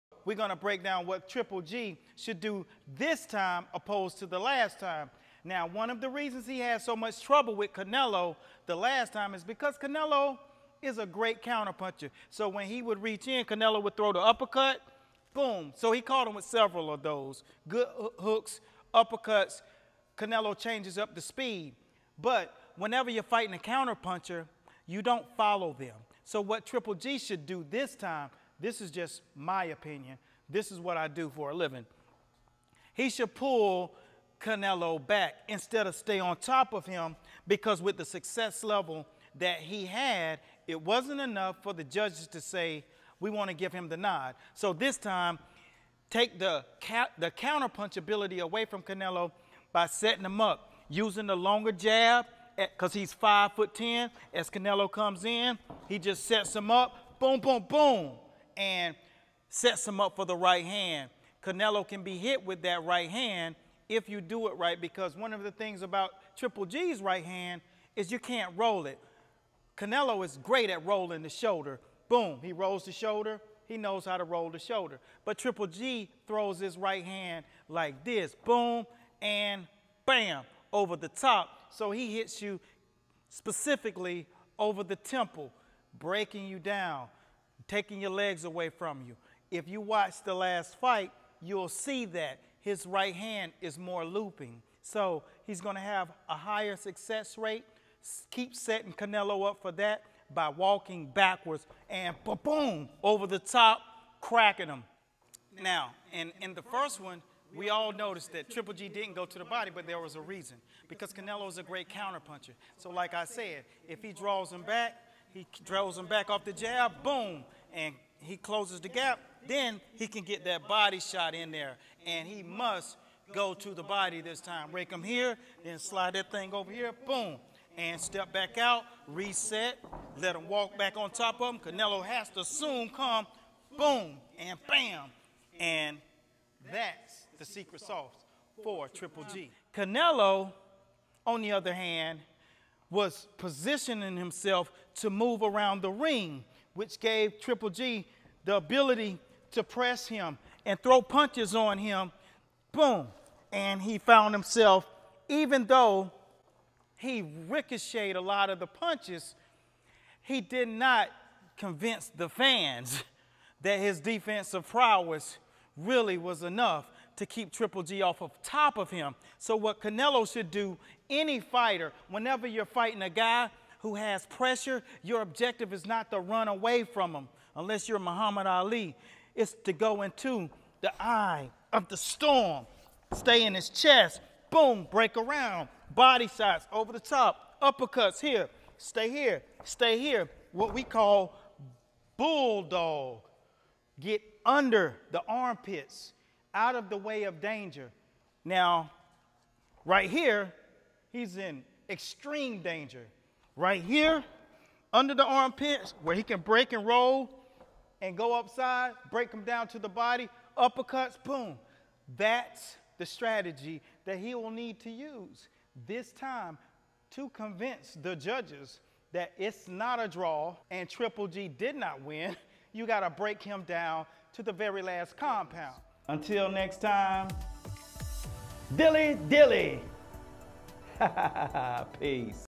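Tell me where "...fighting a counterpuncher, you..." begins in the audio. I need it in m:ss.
0:23.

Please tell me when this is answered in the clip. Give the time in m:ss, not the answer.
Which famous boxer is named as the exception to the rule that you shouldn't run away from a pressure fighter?
2:57.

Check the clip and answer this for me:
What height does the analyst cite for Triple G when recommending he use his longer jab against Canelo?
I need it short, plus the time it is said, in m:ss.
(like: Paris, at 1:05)
5 foot 10, at 0:53.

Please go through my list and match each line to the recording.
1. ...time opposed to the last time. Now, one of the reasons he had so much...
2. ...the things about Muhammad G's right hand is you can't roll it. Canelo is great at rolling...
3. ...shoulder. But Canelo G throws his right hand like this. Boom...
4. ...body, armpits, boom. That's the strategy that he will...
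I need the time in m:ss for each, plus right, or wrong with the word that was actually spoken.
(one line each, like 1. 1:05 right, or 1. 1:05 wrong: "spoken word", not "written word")
1. 0:03 right
2. 1:05 wrong: "Triple", not "Muhammad"
3. 1:14 wrong: "Triple", not "Canelo"
4. 3:29 wrong: "uppercuts", not "armpits".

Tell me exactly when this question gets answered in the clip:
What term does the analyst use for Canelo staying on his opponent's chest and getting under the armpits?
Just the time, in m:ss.
3:12.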